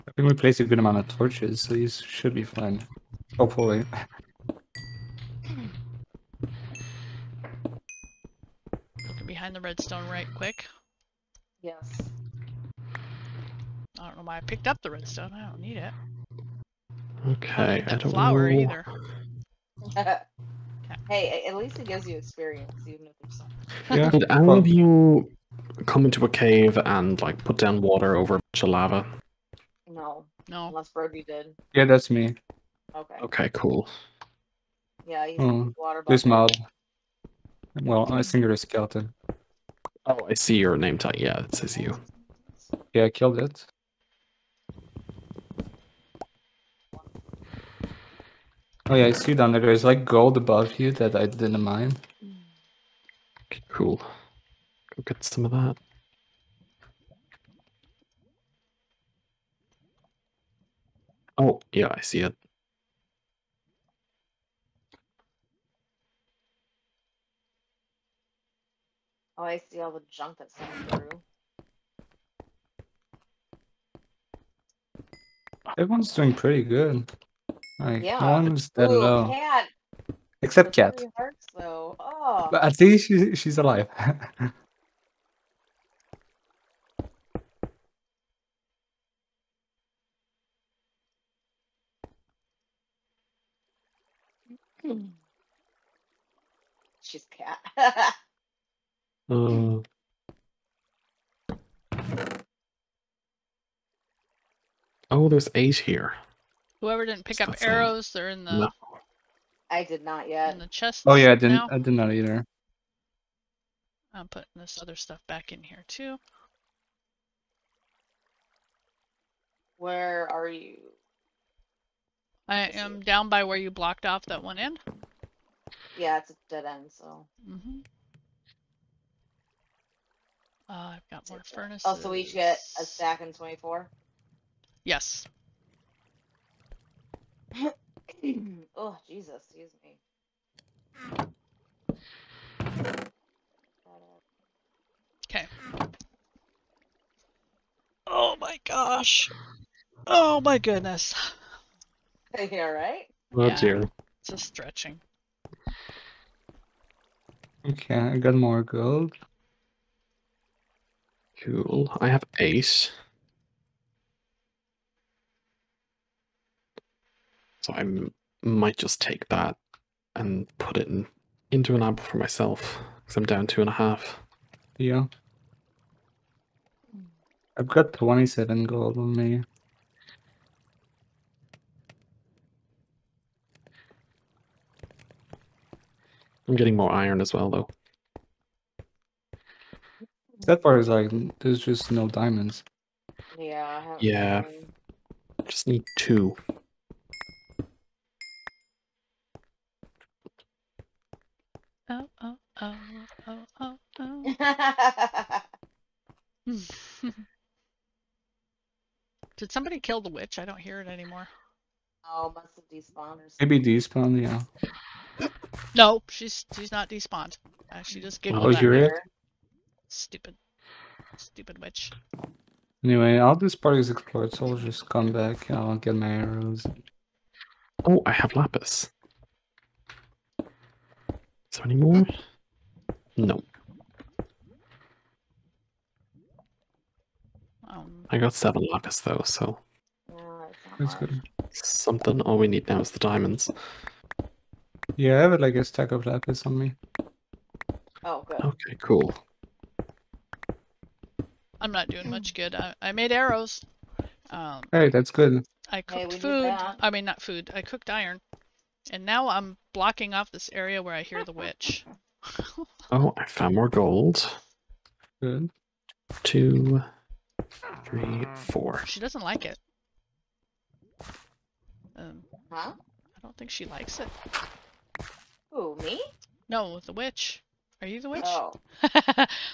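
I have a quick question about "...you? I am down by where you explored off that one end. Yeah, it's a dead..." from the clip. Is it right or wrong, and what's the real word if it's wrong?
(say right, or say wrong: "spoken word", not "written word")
wrong: "blocked", not "explored".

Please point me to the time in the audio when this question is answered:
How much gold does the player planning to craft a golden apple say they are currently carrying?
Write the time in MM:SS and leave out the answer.
02:57.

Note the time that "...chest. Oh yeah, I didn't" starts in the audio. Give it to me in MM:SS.
01:50.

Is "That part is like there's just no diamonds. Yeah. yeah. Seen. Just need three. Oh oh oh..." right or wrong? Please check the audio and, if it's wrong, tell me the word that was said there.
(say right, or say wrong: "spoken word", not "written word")
wrong: "two", not "three".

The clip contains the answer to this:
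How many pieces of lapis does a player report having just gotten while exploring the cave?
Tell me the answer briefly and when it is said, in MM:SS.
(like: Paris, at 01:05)
7, at 03:58.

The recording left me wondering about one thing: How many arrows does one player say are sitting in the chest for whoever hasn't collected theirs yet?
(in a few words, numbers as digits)
8.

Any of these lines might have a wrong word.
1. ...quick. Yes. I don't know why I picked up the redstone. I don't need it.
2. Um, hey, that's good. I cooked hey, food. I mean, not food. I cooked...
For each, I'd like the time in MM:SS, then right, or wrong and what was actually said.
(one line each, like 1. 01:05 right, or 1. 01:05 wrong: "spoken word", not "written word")
1. 00:10 right
2. 04:14 right.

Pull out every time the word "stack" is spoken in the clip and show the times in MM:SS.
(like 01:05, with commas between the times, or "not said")
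02:12, 04:05.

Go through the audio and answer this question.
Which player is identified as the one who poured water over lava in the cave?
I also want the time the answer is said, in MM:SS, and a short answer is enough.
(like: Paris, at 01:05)
Brody, at 00:30.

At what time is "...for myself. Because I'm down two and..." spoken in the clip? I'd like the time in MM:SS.
02:52.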